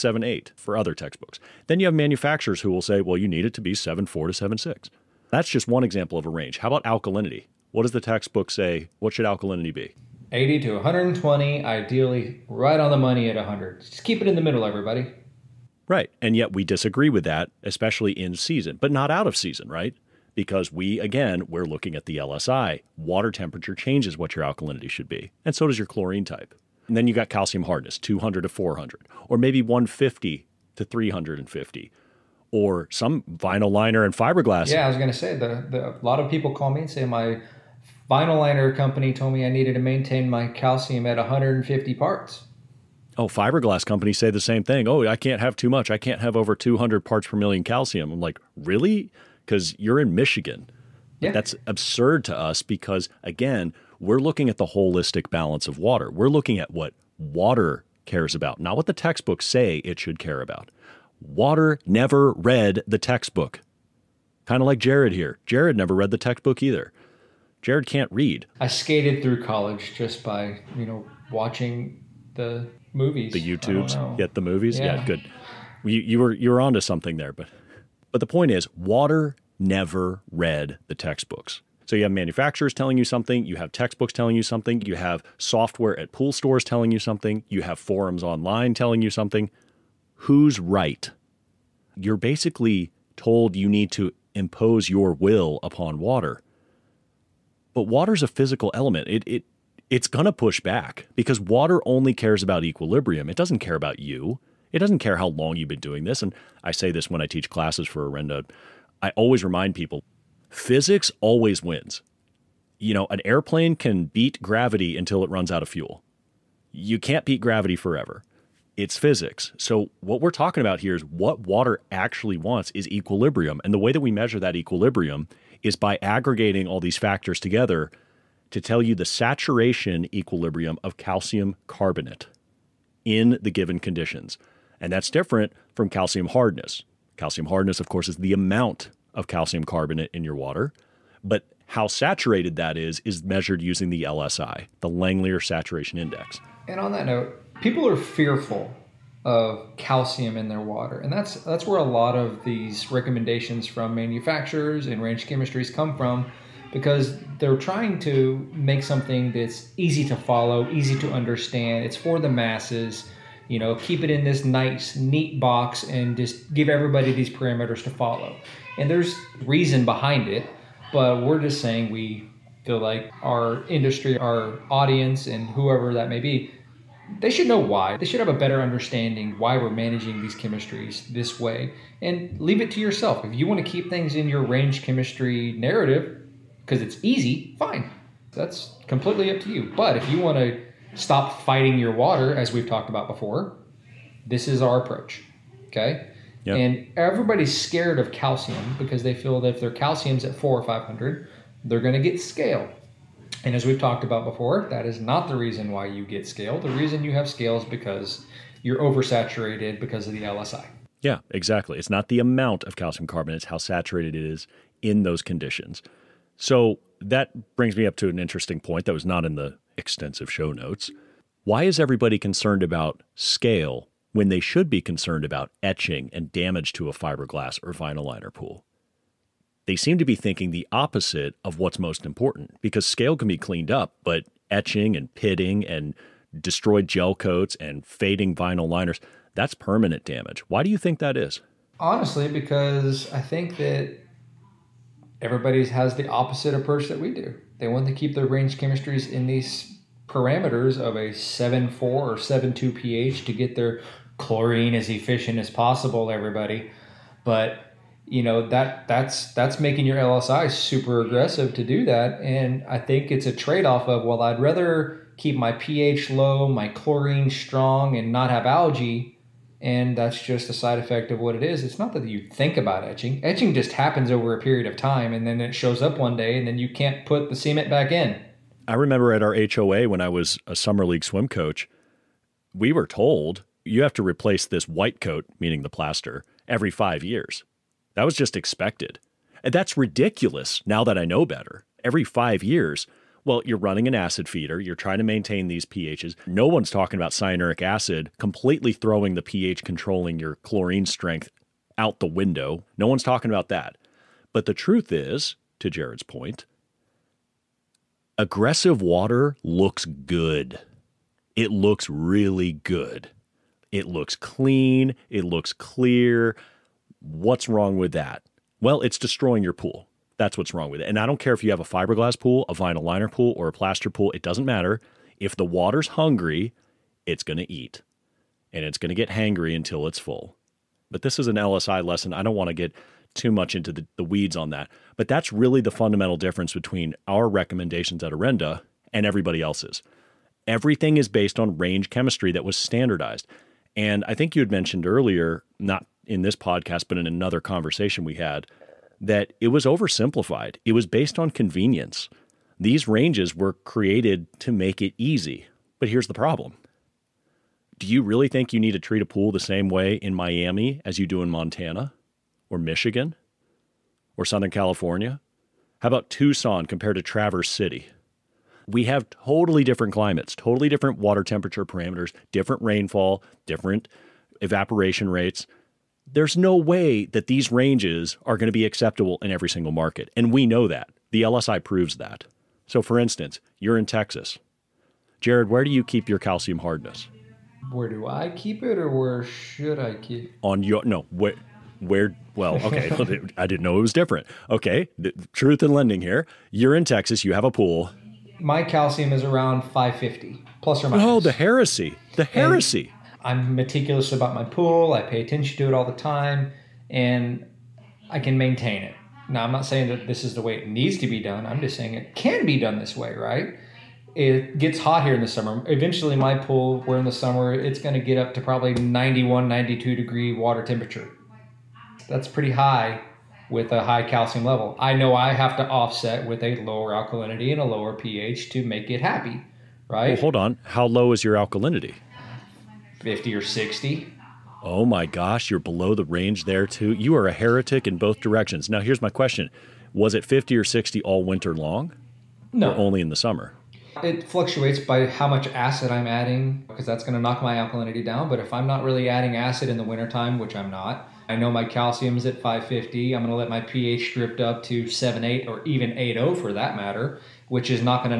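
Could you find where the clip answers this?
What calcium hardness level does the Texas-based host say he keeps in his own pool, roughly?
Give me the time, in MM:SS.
06:39.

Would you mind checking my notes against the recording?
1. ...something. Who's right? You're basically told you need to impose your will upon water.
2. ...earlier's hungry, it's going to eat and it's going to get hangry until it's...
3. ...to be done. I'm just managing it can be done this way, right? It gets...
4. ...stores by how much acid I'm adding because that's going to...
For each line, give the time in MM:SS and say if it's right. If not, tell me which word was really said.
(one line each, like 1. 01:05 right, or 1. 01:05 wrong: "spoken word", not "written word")
1. 01:29 right
2. 05:25 wrong: "water", not "earlier"
3. 06:50 wrong: "saying", not "managing"
4. 07:24 wrong: "fluctuates", not "stores".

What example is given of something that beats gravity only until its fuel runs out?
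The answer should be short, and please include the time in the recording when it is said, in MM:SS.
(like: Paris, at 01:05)
An airplane, at 01:53.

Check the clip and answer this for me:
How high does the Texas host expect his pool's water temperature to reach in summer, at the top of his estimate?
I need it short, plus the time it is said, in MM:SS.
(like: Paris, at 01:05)
92 degrees, at 06:59.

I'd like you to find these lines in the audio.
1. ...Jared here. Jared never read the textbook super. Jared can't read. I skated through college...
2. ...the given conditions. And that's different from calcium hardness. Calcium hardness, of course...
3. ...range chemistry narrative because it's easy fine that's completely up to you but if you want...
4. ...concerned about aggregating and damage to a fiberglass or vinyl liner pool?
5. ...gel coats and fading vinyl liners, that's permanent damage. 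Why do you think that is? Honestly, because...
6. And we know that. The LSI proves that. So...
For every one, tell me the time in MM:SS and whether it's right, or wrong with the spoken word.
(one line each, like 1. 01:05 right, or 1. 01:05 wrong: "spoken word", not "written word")
1. 01:04 wrong: "either", not "super"
2. 02:13 right
3. 03:04 right
4. 03:44 wrong: "etching", not "aggregating"
5. 03:56 right
6. 06:20 right.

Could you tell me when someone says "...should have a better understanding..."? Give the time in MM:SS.
02:58.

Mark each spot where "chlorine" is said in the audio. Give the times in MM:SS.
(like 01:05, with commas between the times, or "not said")
00:25, 04:14, 04:26, 05:00.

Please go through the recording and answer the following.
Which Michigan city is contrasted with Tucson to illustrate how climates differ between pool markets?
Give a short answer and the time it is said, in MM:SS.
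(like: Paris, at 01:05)
Traverse City, at 06:07.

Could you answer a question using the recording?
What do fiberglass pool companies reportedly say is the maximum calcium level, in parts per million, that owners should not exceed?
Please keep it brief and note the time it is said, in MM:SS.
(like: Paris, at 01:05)
200, at 00:46.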